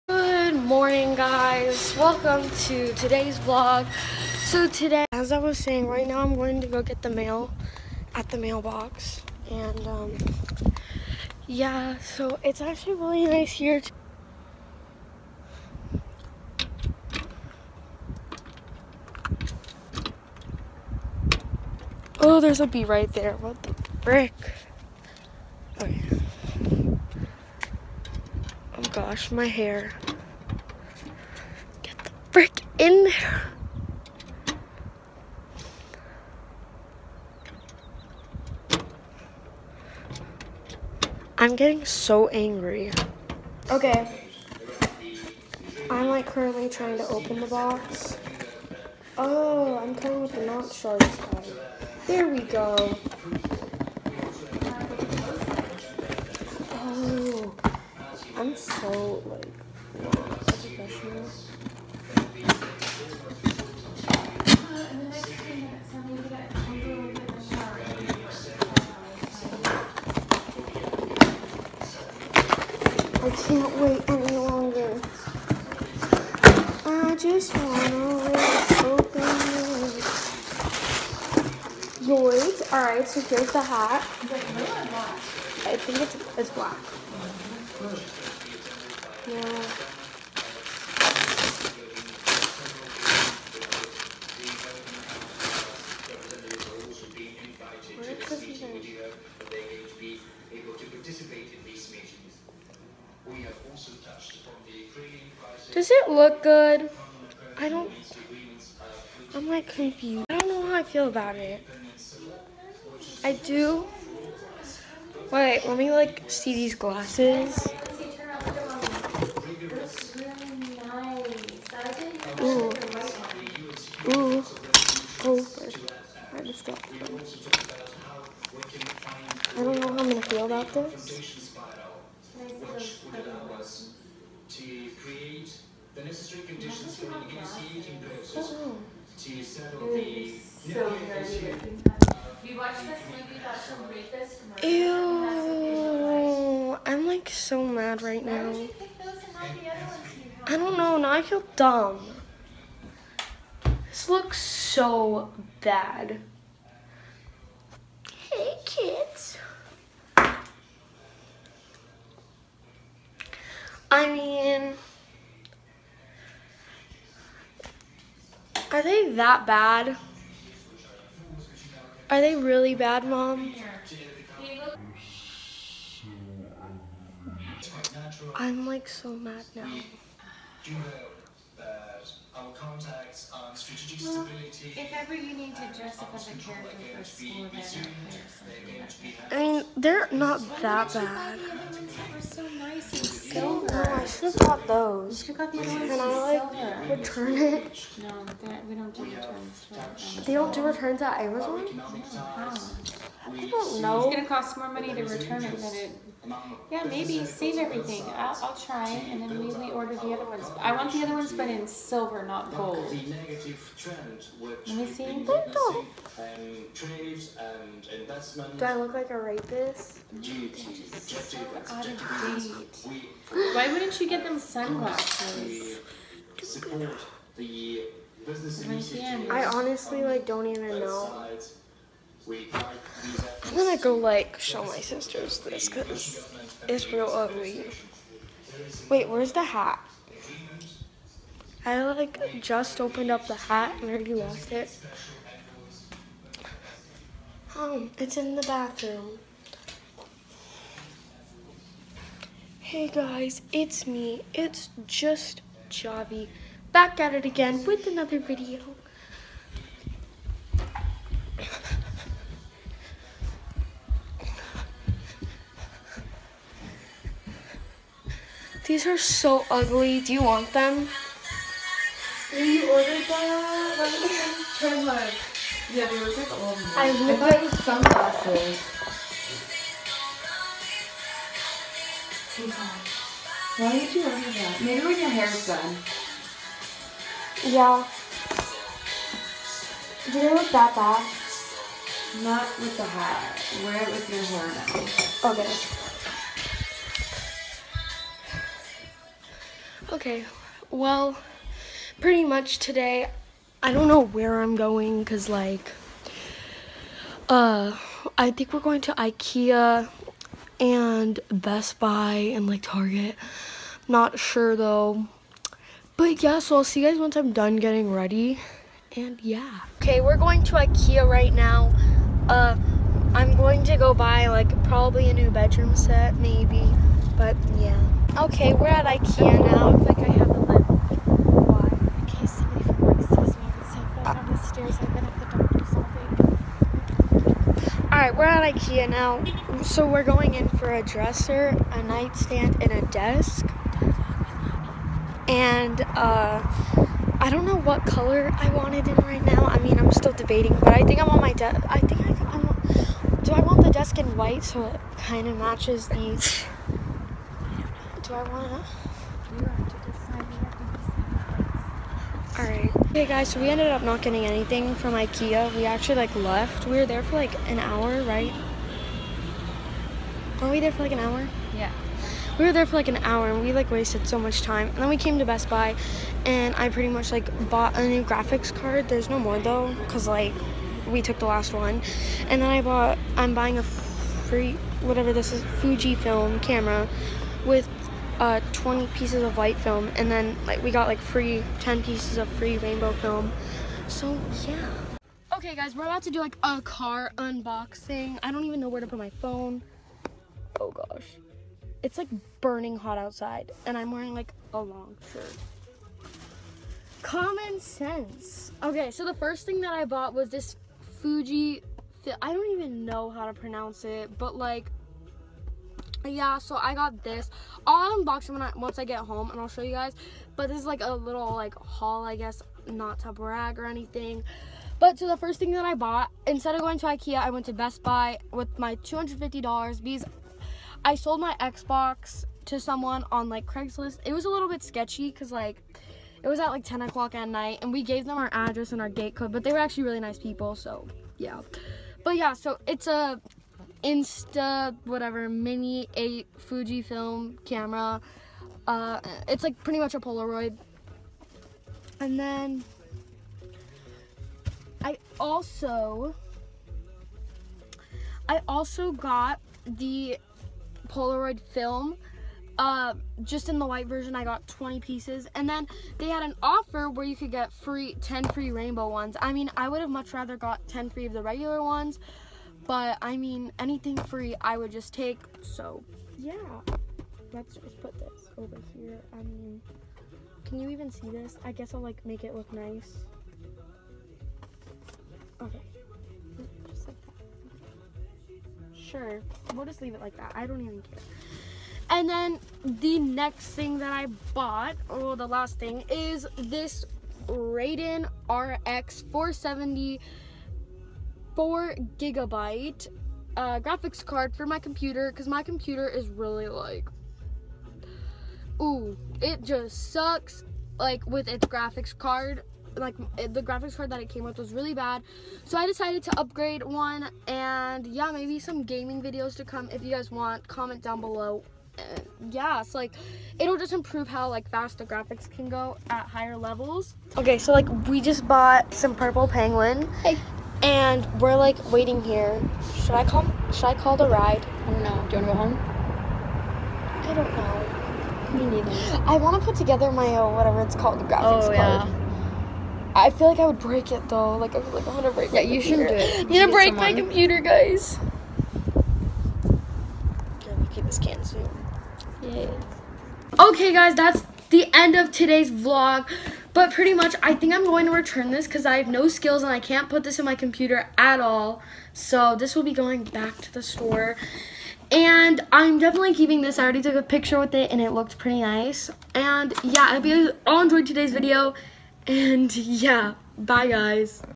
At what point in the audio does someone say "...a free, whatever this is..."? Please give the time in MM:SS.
06:23.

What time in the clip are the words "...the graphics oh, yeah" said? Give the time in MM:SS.
09:00.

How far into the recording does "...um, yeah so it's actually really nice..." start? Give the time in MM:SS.
00:09.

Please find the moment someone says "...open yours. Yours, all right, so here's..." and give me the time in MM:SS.
01:18.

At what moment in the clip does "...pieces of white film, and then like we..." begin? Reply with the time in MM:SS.
06:28.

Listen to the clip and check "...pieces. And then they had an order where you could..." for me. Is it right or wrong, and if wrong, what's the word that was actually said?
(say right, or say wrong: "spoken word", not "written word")
wrong: "offer", not "order".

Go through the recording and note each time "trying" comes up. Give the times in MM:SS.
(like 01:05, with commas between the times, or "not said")
00:46.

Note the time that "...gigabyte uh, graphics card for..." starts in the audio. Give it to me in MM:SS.
08:21.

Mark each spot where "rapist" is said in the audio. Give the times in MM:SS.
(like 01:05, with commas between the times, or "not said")
03:39.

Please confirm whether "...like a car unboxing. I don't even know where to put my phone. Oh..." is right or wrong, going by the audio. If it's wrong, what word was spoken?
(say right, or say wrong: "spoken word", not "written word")
right.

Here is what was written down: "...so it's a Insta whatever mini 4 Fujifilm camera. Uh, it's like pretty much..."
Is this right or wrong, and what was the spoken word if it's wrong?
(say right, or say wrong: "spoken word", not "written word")
wrong: "8", not "4".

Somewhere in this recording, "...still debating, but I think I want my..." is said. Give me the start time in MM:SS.
05:49.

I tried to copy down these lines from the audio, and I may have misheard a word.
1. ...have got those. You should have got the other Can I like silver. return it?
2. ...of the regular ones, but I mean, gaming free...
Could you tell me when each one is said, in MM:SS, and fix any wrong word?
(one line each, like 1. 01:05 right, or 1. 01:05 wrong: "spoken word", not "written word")
1. 03:14 right
2. 07:51 wrong: "anything", not "gaming".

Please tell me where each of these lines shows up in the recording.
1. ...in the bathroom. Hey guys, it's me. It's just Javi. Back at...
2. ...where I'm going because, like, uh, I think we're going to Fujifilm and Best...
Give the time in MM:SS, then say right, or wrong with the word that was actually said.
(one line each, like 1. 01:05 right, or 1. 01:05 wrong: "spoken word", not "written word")
1. 04:08 right
2. 05:03 wrong: "Ikea", not "Fujifilm".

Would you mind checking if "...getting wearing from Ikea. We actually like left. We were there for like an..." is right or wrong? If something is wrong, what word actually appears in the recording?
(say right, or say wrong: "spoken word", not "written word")
wrong: "anything", not "wearing".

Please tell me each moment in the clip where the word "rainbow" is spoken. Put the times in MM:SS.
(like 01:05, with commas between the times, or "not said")
06:32, 07:48.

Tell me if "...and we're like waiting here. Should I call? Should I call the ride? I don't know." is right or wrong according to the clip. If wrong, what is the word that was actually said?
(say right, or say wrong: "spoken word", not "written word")
right.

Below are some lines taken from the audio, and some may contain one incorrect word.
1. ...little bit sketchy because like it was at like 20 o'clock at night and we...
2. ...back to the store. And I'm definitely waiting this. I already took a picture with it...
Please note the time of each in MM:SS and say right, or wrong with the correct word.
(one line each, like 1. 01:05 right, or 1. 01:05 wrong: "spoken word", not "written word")
1. 07:14 wrong: "10", not "20"
2. 09:23 wrong: "keeping", not "waiting".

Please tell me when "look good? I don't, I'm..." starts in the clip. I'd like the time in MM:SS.
01:46.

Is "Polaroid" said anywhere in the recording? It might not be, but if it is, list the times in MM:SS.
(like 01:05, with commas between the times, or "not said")
07:29, 07:40.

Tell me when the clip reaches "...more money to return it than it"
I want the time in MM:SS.
03:24.